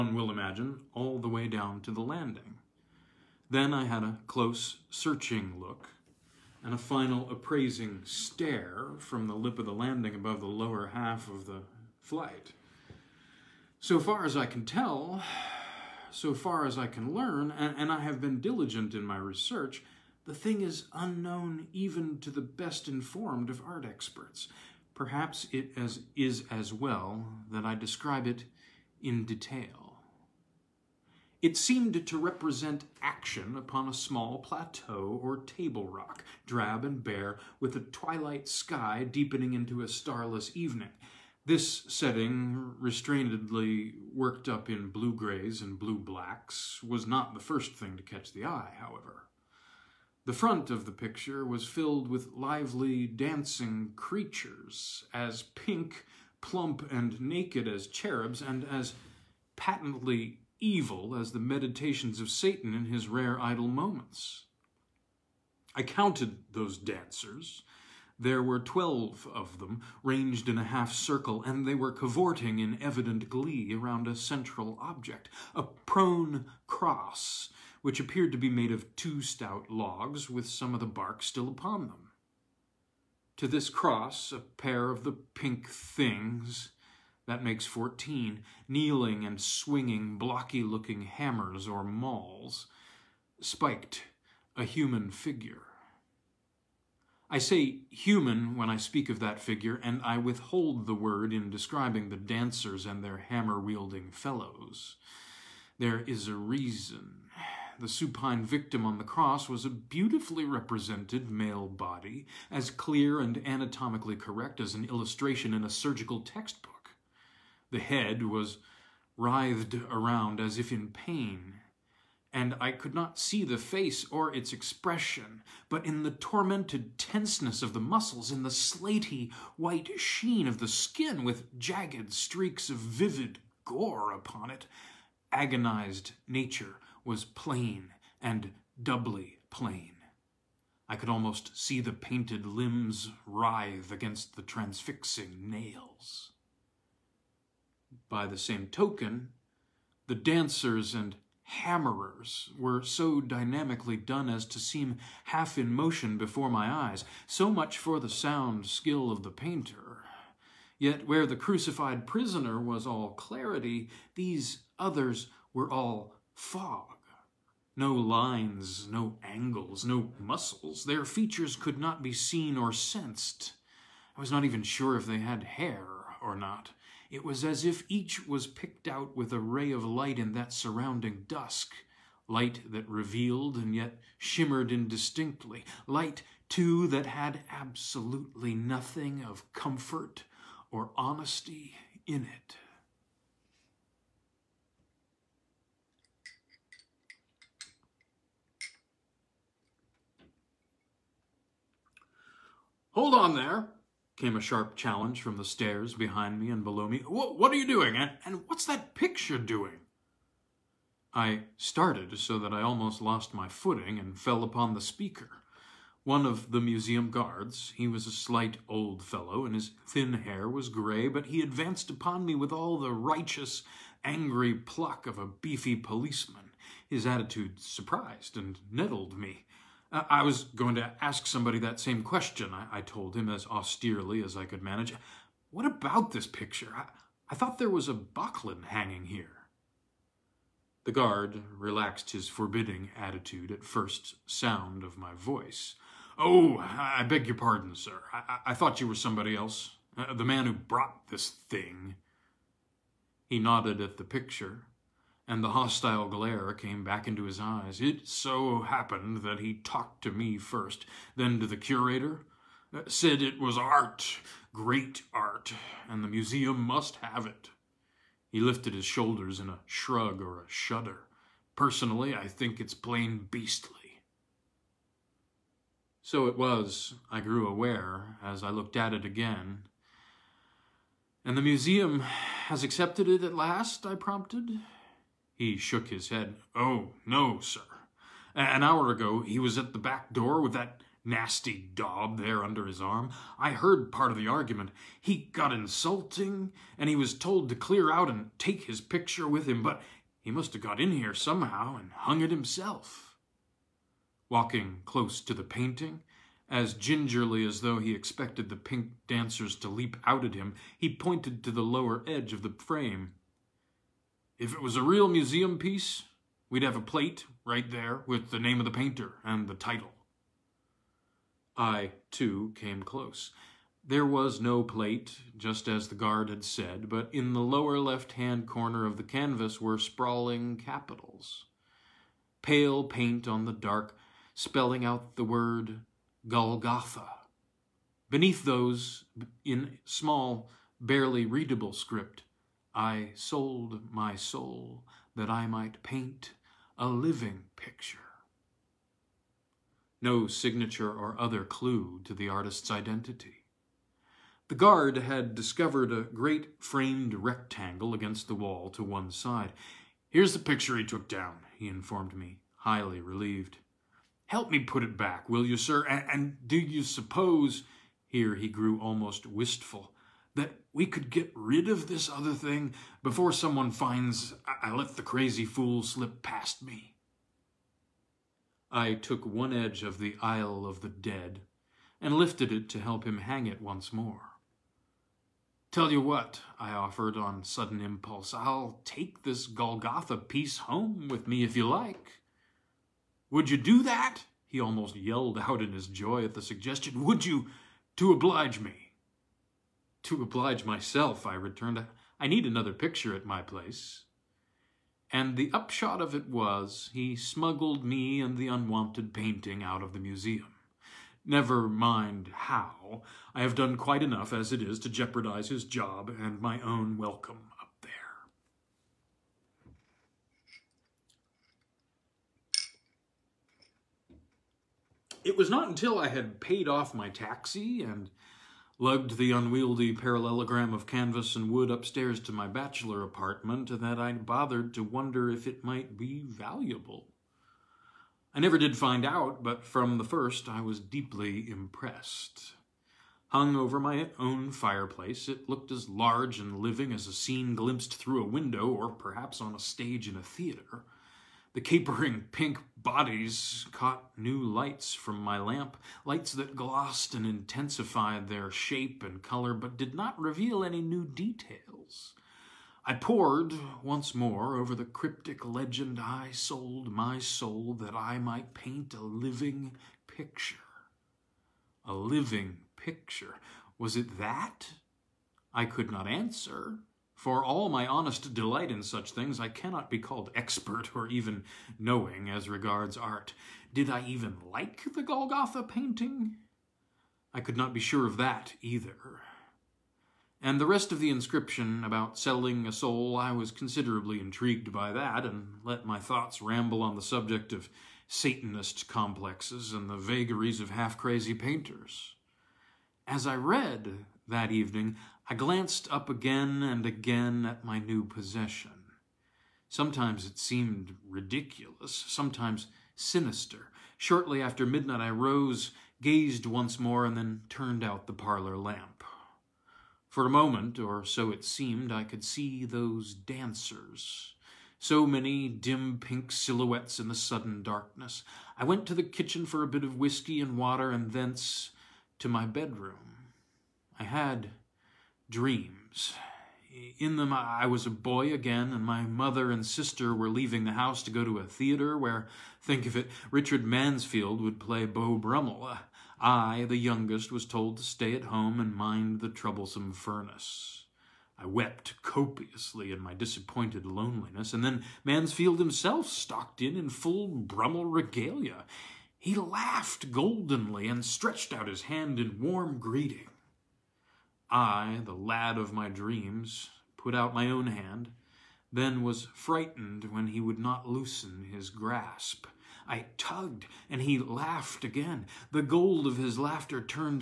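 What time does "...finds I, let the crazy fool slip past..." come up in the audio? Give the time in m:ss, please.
6:13.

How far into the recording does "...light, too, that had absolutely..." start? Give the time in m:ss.
3:05.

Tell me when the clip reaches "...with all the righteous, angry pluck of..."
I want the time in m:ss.
3:42.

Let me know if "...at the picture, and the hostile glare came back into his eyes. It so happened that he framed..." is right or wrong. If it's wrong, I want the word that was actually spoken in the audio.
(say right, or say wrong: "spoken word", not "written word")
wrong: "talked", not "framed".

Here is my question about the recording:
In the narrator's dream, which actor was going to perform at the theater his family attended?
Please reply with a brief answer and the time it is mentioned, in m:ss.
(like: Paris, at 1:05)
Richard Mansfield, at 9:03.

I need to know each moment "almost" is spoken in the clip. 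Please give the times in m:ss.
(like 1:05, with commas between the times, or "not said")
2:21, 3:32, 6:08, 6:34.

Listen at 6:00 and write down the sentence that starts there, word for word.
Here's the picture he took down, he informed me, highly relieved.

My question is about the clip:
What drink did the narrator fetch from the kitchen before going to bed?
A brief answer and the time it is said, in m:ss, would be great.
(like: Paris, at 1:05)
whiskey and water, at 8:49.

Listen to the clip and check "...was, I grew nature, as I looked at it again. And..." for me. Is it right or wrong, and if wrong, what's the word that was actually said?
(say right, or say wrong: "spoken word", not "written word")
wrong: "aware", not "nature".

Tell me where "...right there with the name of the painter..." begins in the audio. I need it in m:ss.
5:17.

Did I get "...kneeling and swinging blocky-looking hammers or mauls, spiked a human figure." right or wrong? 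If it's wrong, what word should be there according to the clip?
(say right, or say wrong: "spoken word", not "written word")
right.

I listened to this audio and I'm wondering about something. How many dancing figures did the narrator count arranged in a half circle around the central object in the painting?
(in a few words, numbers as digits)
12.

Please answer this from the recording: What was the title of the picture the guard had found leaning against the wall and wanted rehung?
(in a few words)
Isle of the Dead.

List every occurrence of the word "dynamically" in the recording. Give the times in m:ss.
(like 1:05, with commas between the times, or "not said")
2:33.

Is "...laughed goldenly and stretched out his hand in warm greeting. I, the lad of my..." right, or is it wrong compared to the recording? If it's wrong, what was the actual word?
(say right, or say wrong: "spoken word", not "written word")
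right.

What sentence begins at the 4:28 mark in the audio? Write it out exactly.
He lifted his shoulders in a shrug or a shudder.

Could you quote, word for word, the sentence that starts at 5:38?
Beneath those, in small, barely readable script, I sold my soul that I might paint a living picture.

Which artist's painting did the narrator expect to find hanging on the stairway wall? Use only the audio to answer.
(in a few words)
Böcklin.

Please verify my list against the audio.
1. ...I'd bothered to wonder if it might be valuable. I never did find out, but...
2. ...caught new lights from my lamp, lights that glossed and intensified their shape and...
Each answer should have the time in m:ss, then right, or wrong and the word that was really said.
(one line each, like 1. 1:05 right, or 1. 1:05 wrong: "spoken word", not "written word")
1. 7:13 right
2. 7:33 right.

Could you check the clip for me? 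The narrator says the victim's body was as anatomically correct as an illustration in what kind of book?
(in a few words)
surgical textbook.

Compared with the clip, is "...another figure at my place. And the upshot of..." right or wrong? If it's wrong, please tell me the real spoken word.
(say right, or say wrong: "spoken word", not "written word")
wrong: "picture", not "figure".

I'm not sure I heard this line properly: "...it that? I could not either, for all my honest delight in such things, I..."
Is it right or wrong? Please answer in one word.
wrong.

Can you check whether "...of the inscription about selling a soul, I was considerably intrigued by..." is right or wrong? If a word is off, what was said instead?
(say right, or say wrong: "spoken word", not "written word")
right.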